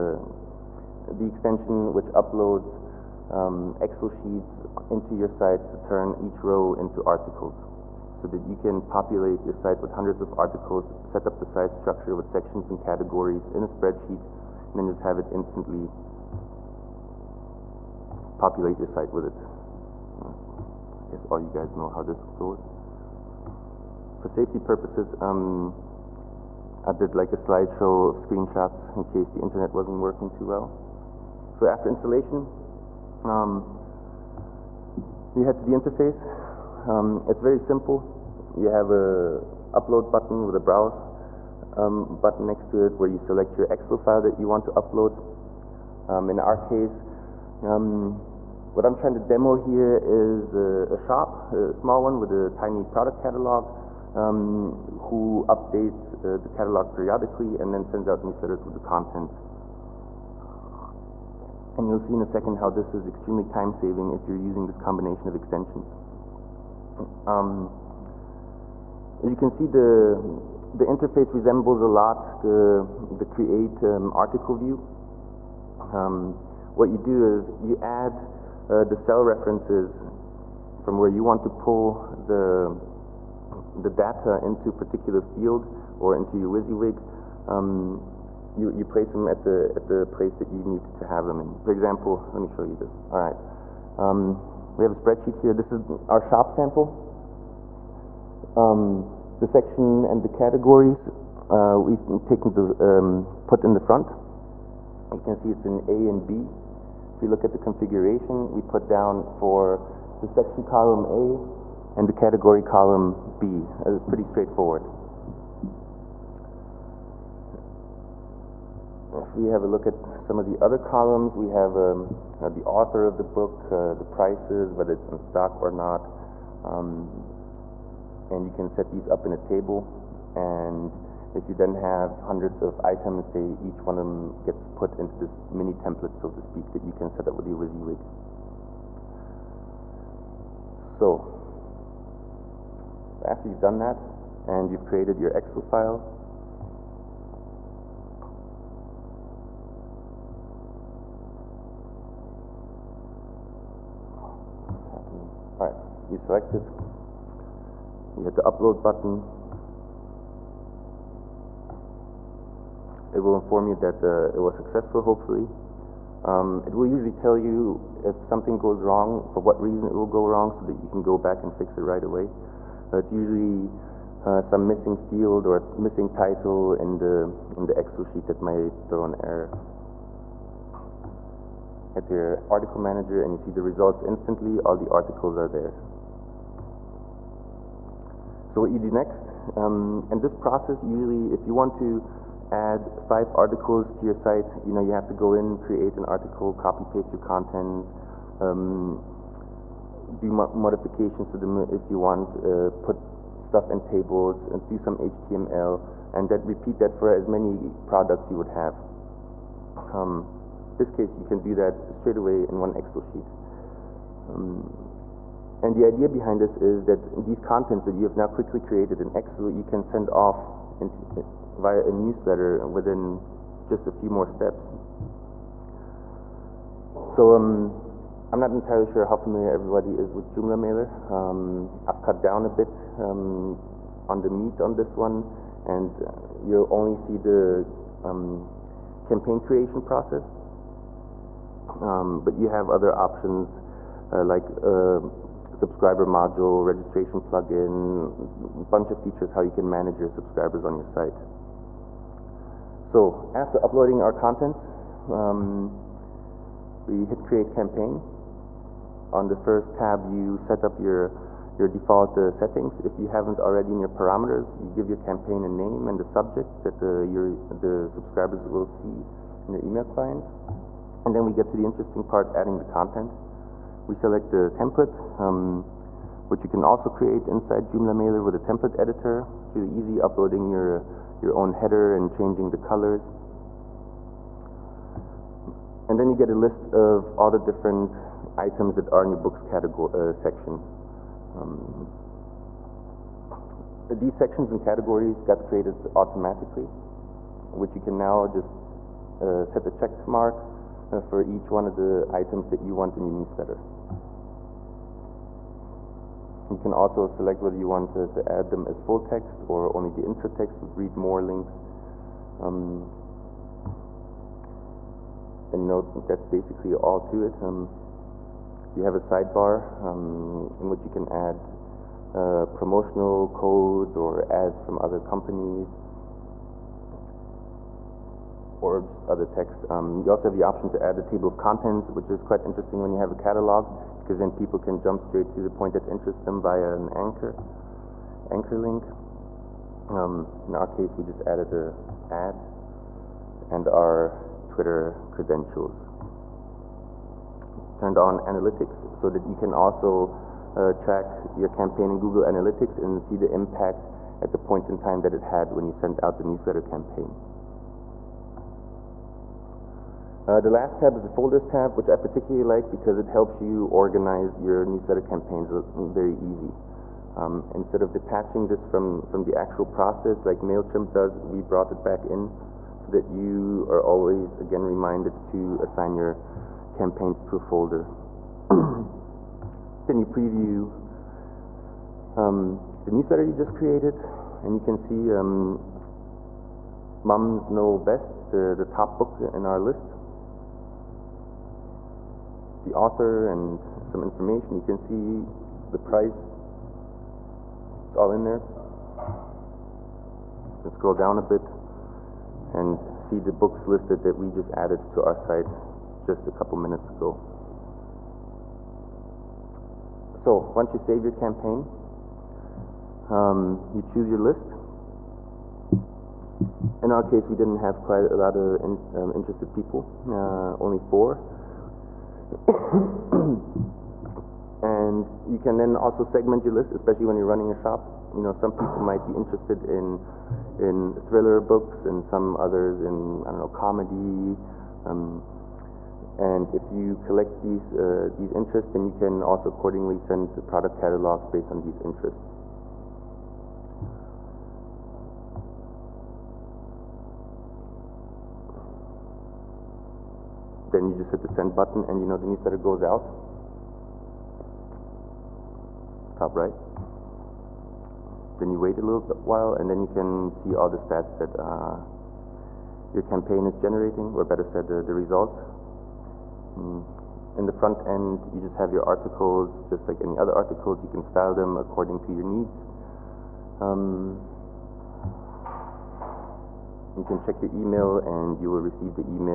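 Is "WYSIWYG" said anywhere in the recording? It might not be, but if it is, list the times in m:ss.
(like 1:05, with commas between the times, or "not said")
1:26, 2:17.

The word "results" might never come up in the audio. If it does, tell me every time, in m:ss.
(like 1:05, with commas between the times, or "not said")
3:03, 7:44.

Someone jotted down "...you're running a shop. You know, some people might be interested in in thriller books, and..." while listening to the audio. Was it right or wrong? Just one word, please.
right.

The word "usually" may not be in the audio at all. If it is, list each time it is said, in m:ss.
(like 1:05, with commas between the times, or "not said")
2:46, 2:53, 3:10.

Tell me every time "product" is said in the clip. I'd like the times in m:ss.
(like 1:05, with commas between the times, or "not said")
0:52, 3:27, 7:20.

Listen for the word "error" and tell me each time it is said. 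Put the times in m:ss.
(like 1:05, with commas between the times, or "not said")
2:59.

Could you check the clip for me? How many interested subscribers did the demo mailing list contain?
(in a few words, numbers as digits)
4.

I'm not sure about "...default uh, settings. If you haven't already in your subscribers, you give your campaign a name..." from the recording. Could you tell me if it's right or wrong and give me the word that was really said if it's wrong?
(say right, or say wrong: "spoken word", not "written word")
wrong: "parameters", not "subscribers".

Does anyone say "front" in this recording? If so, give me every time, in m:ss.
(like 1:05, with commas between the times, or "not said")
1:43, 7:47.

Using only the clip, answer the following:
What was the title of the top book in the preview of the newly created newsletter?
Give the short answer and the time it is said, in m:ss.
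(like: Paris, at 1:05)
Mums Know Best, at 6:27.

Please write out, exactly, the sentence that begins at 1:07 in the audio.
Um, as you can see, the, the interface resembles a lot the, the create um, article view.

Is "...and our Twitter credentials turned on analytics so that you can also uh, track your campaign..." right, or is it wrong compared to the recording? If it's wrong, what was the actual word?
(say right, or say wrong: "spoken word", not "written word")
right.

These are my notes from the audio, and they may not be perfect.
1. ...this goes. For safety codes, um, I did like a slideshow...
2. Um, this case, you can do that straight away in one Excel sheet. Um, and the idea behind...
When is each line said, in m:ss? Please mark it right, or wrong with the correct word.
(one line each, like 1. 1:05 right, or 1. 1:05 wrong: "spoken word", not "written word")
1. 0:22 wrong: "purposes", not "codes"
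2. 3:29 right.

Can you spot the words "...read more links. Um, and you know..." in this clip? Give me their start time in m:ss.
5:10.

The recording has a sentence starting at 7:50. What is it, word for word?
You can style them according to your needs.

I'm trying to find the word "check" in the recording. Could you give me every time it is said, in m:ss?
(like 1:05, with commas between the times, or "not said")
4:59, 7:57.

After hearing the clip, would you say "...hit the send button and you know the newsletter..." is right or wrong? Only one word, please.
right.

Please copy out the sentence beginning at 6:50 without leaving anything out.
So, once you save your campaign, um, you choose your list.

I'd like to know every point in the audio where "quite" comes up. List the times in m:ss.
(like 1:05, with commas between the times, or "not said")
5:32, 6:57.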